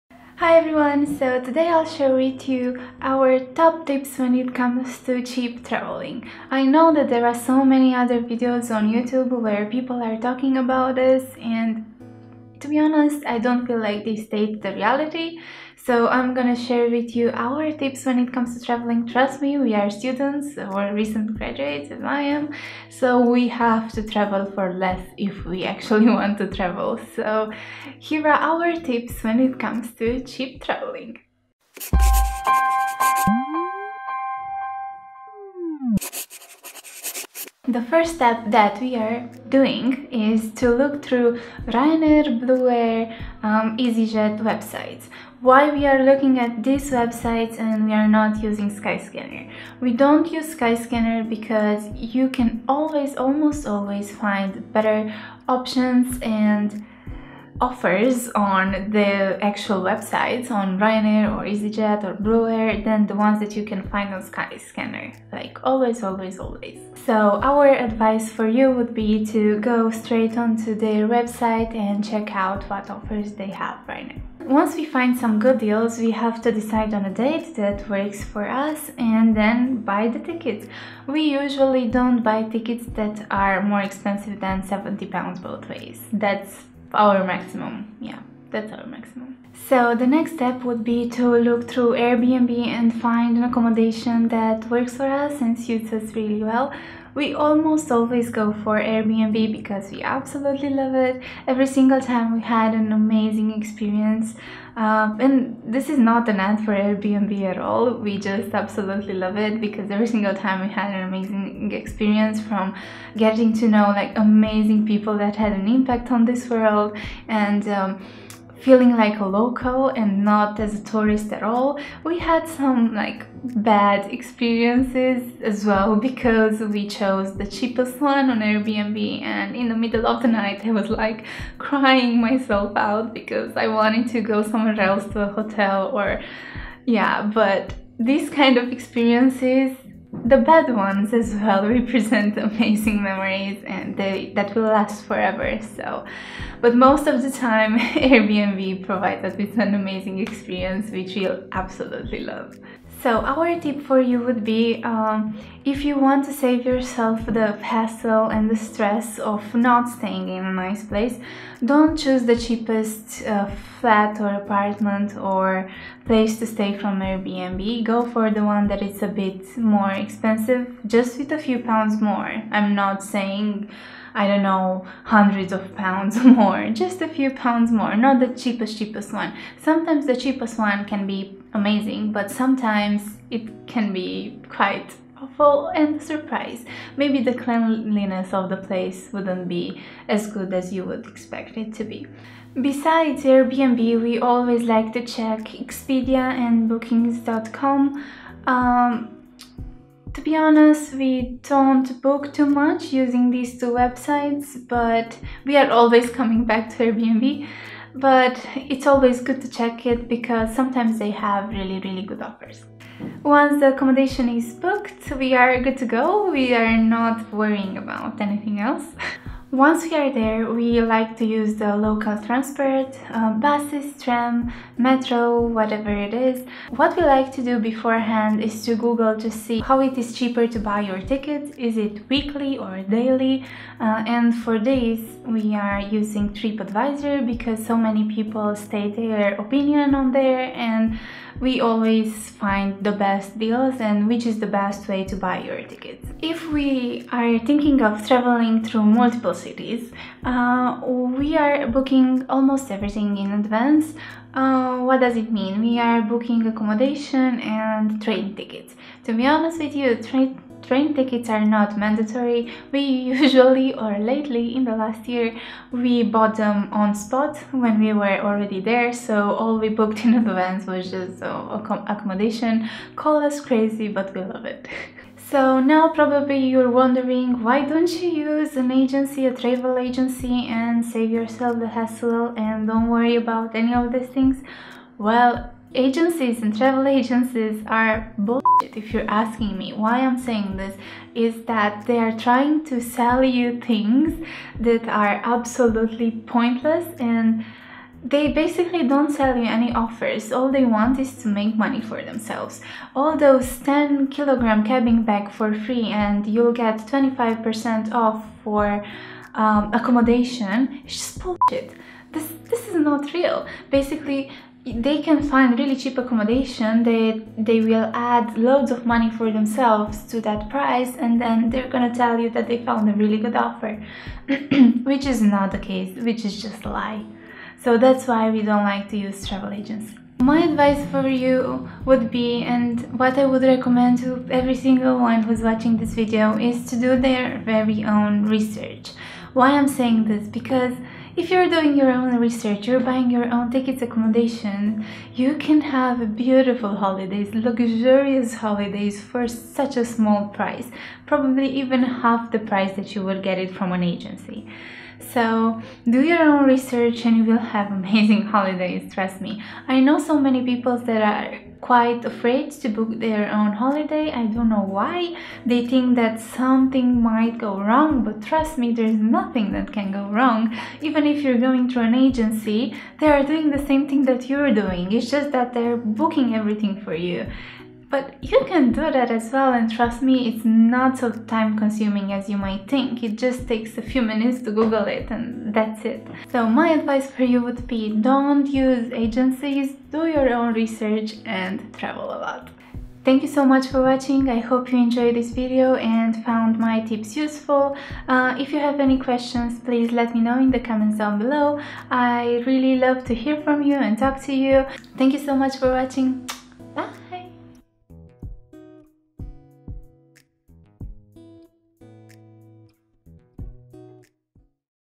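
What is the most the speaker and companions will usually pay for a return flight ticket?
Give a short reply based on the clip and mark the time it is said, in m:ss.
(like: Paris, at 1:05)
70 pounds, at 1:24.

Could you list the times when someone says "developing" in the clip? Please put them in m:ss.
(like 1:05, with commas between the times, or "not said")
not said.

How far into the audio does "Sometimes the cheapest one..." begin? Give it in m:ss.
2:59.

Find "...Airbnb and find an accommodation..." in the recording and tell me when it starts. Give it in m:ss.
1:31.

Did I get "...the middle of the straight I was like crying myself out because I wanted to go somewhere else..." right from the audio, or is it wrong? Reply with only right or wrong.
wrong.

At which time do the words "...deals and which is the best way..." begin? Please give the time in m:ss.
4:03.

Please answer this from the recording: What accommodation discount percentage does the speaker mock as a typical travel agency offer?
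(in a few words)
25%.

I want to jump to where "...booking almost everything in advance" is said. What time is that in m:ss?
4:11.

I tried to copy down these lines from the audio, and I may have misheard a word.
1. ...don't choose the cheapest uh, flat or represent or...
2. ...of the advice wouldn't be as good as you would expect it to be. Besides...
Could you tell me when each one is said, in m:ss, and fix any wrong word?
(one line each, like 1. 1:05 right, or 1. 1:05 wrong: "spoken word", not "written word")
1. 2:41 wrong: "apartment", not "represent"
2. 3:08 wrong: "place", not "advice".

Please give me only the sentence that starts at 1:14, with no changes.
Once we find some good deals, we have to decide on a date that works for us and then buy the tickets.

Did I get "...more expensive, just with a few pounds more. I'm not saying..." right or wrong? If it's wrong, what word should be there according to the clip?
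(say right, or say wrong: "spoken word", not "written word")
right.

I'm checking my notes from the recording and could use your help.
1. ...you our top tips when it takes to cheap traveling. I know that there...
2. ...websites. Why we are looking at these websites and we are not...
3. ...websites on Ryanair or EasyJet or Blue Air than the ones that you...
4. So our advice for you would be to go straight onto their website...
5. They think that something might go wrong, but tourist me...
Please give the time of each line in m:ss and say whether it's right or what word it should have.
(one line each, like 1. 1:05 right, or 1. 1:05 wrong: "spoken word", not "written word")
1. 0:02 wrong: "comes", not "takes"
2. 0:44 right
3. 0:59 right
4. 1:07 right
5. 6:05 wrong: "trust", not "tourist".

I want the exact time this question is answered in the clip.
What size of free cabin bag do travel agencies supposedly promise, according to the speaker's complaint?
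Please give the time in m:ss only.
5:03.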